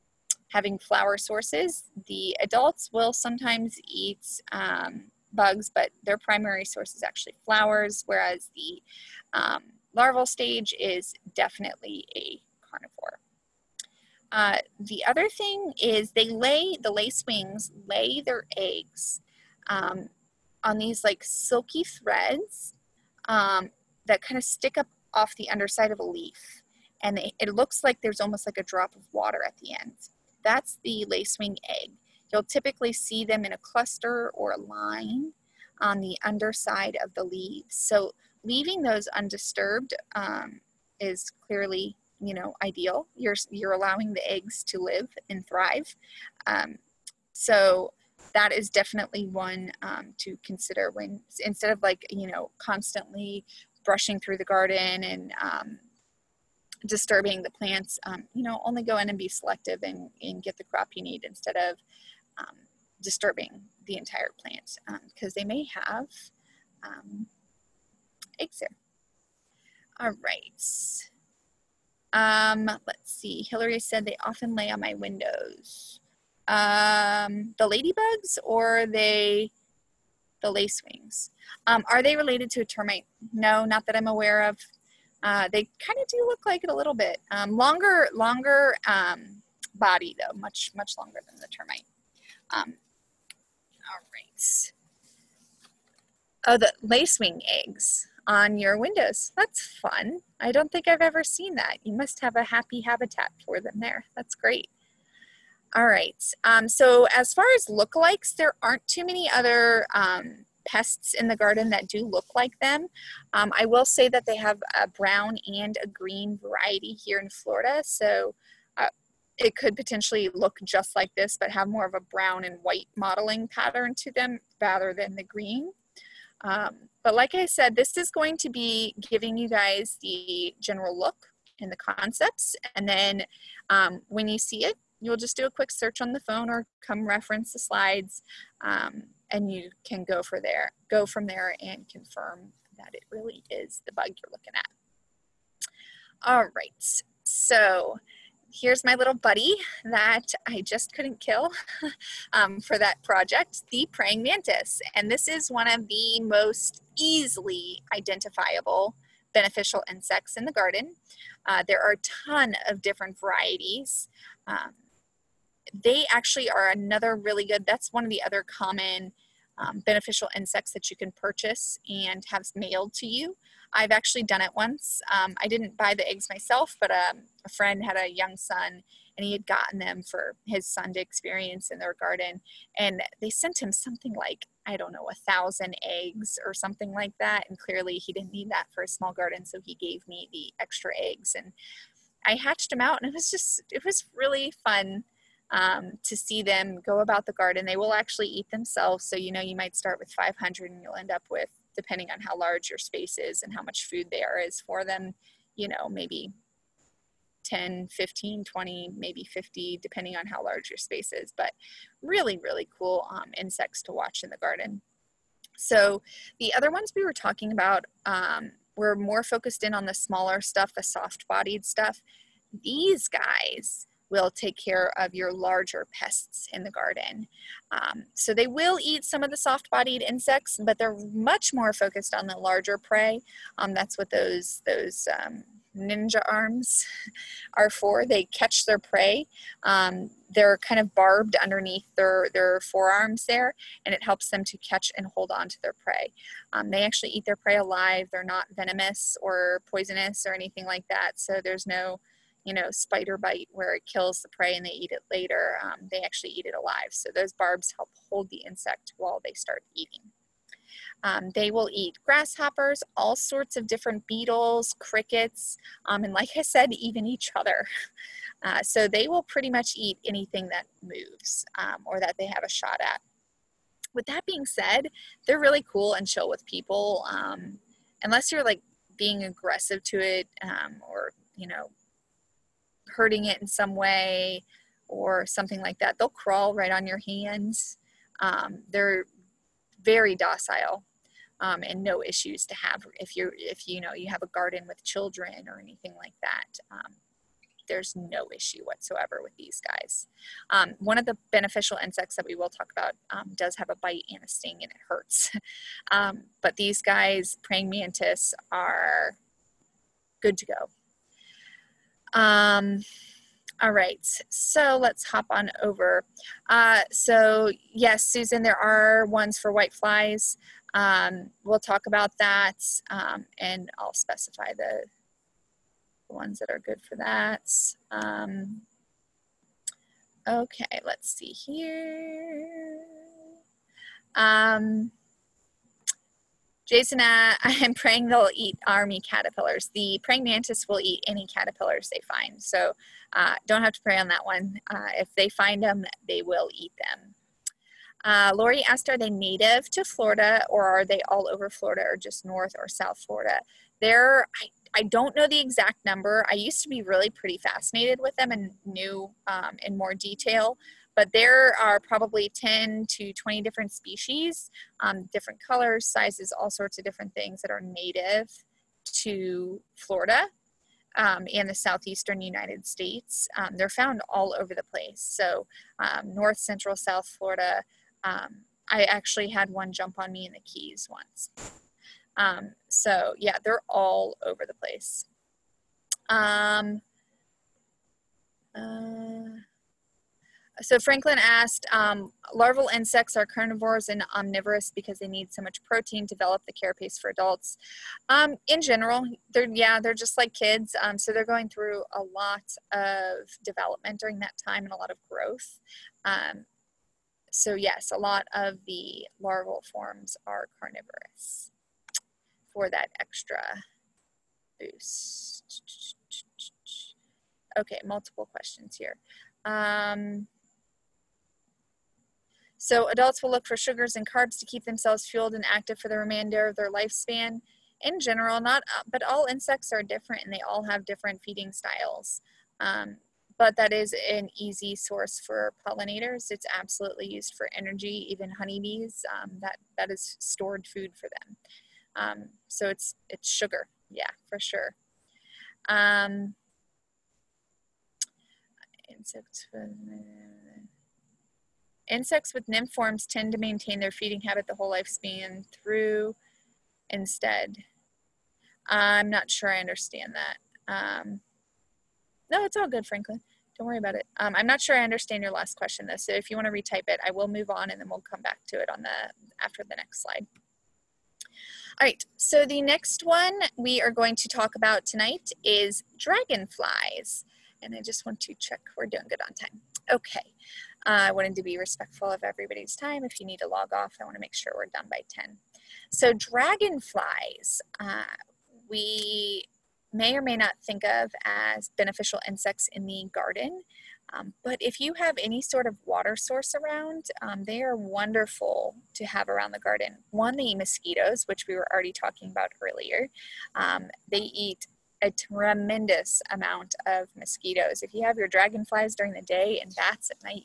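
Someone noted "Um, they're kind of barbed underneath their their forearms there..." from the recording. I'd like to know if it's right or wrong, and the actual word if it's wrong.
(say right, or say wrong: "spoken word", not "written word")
right.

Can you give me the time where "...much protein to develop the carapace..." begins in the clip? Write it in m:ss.
6:35.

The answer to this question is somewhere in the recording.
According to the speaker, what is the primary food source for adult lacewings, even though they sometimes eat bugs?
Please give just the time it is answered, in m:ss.
0:07.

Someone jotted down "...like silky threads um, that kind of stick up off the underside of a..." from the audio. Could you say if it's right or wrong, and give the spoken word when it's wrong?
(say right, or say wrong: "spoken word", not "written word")
right.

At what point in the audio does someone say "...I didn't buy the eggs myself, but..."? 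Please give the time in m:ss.
2:55.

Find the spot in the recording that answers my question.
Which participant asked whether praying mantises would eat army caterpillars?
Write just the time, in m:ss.
5:36.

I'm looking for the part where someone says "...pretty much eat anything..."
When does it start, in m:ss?
4:29.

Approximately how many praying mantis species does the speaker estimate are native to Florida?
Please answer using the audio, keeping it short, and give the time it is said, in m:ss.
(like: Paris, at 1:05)
10 to 20, at 6:02.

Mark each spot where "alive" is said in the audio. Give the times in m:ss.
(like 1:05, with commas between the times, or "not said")
4:07, 4:16.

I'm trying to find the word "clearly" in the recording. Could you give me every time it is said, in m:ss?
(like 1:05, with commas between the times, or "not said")
0:41, 3:07.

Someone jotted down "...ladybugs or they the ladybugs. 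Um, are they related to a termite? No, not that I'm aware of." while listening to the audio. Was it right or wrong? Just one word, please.
wrong.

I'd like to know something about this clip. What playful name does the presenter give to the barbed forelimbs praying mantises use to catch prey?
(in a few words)
Ninja arms.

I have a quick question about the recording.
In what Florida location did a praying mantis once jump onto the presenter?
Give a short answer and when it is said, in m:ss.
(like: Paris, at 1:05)
The Keys, at 6:20.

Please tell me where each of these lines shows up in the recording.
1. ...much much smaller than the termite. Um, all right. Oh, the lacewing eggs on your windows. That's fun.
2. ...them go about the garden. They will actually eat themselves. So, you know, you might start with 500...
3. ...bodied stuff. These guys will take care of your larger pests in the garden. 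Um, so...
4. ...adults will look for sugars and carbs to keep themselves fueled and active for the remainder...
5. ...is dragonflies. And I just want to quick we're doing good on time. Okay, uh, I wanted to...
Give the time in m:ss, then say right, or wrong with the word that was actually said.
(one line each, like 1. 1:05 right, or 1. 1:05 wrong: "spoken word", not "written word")
1. 1:30 wrong: "longer", not "smaller"
2. 3:16 right
3. 3:41 right
4. 7:02 right
5. 7:55 wrong: "check", not "quick".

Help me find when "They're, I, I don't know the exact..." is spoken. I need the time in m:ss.
5:53.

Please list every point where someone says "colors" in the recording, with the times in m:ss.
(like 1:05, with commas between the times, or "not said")
6:05.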